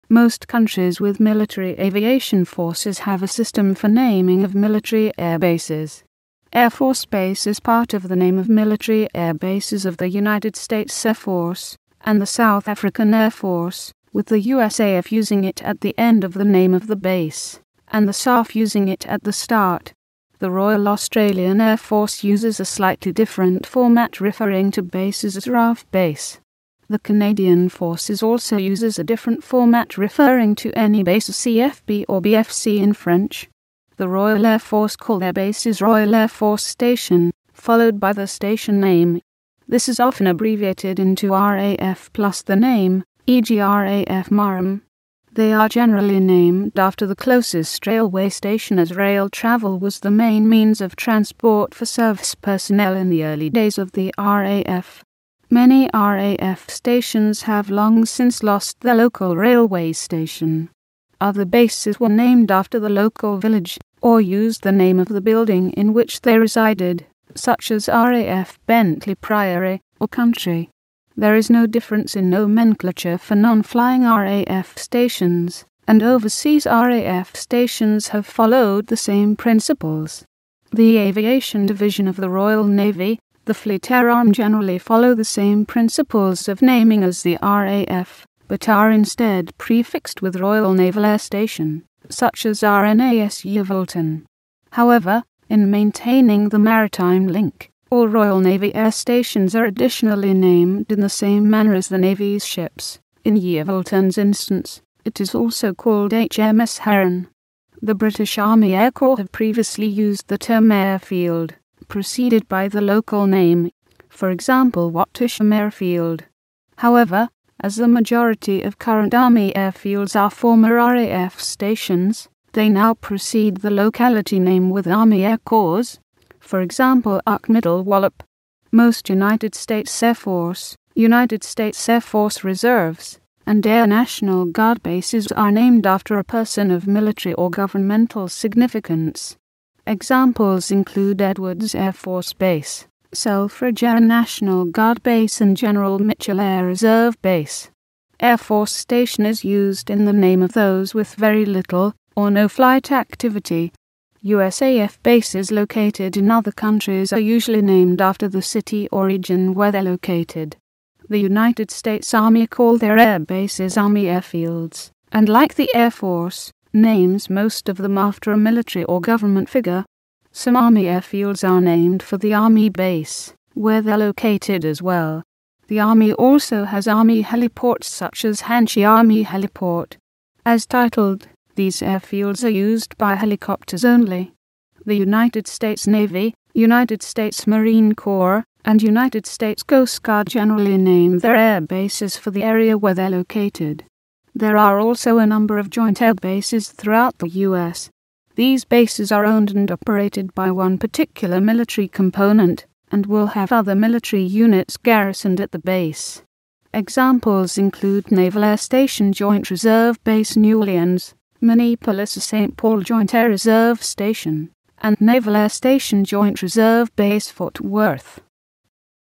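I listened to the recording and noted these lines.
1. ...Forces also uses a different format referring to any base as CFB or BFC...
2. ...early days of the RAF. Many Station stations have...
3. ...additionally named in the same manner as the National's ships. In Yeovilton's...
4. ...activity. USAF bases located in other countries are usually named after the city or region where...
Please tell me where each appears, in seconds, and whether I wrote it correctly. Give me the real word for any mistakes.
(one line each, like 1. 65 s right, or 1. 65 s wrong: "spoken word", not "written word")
1. 27 s right
2. 53 s wrong: "RAF", not "Station"
3. 99 s wrong: "Navy", not "National"
4. 152 s right.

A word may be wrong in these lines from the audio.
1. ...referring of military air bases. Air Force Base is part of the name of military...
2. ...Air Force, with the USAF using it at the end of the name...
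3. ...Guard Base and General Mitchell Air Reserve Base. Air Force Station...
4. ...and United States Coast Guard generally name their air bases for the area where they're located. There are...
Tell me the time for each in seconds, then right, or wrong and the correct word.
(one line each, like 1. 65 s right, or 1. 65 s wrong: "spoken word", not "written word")
1. 3 s wrong: "naming", not "referring"
2. 13 s right
3. 144 s right
4. 188 s right.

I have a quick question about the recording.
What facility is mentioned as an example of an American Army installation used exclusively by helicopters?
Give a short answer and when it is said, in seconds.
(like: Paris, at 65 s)
Hanchey Army Heliport, at 178 s.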